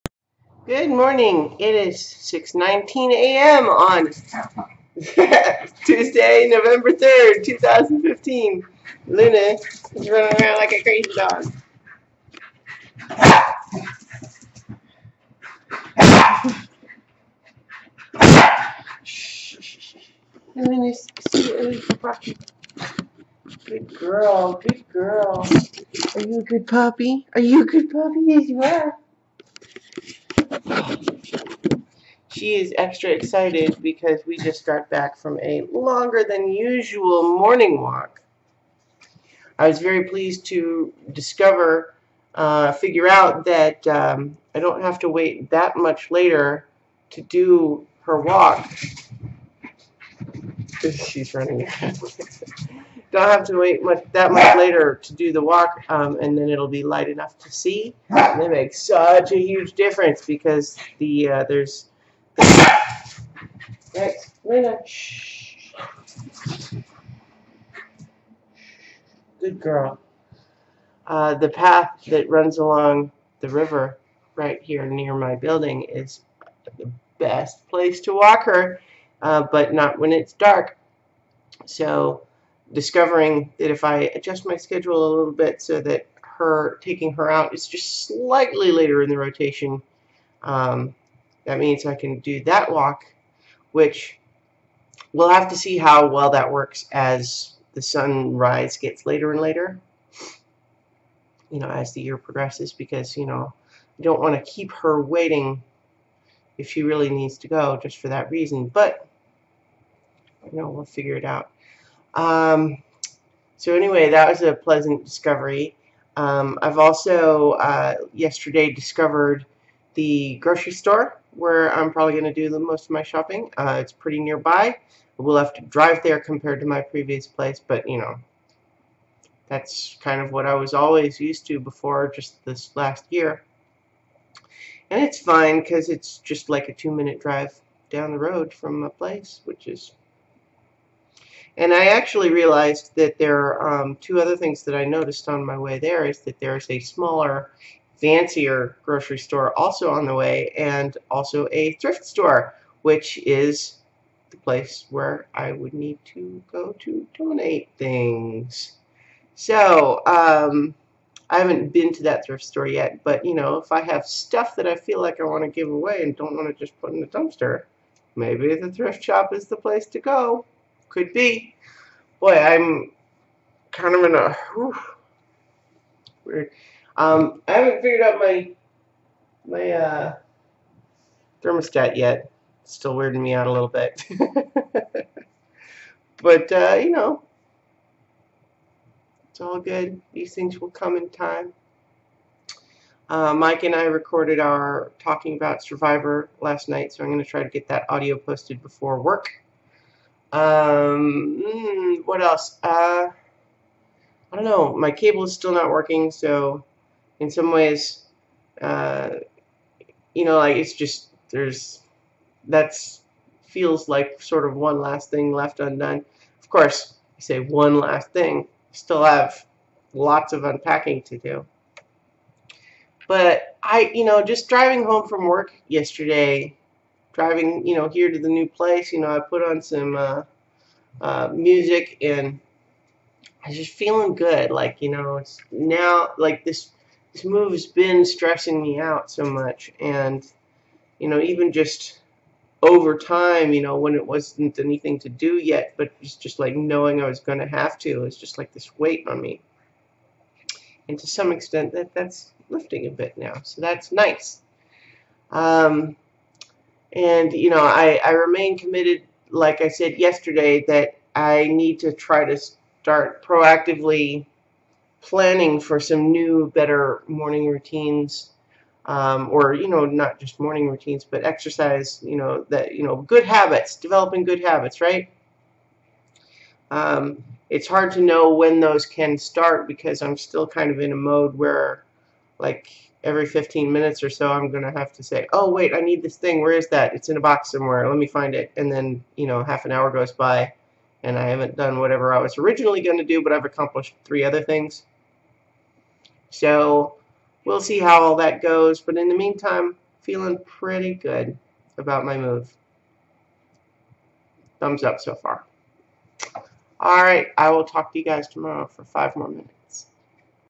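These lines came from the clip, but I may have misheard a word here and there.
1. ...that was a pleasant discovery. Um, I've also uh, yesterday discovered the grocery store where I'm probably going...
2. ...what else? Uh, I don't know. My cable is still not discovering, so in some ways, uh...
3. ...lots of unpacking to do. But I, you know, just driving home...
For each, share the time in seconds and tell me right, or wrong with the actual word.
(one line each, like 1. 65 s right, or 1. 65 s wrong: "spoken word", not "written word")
1. 114 s right
2. 202 s wrong: "working", not "discovering"
3. 219 s right.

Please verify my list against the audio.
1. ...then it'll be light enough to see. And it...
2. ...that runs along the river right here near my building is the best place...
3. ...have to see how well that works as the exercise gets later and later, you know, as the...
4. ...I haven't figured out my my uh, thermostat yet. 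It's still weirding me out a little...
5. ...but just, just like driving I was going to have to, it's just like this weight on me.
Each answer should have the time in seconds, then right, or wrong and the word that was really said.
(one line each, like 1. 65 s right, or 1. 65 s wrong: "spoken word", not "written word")
1. 56 s right
2. 72 s right
3. 95 s wrong: "sunrise", not "exercise"
4. 177 s right
5. 245 s wrong: "knowing", not "driving".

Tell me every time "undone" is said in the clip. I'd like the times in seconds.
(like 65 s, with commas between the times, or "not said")
215 s.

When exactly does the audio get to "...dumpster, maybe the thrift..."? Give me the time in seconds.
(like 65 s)
167 s.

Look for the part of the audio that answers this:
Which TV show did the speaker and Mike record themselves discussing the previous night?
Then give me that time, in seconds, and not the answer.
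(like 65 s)
195 s.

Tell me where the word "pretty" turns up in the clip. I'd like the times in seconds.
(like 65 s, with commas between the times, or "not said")
123 s, 300 s.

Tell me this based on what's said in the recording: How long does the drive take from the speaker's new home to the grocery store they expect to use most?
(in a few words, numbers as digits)
2 minutes.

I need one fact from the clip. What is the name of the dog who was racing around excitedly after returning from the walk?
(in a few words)
Luna.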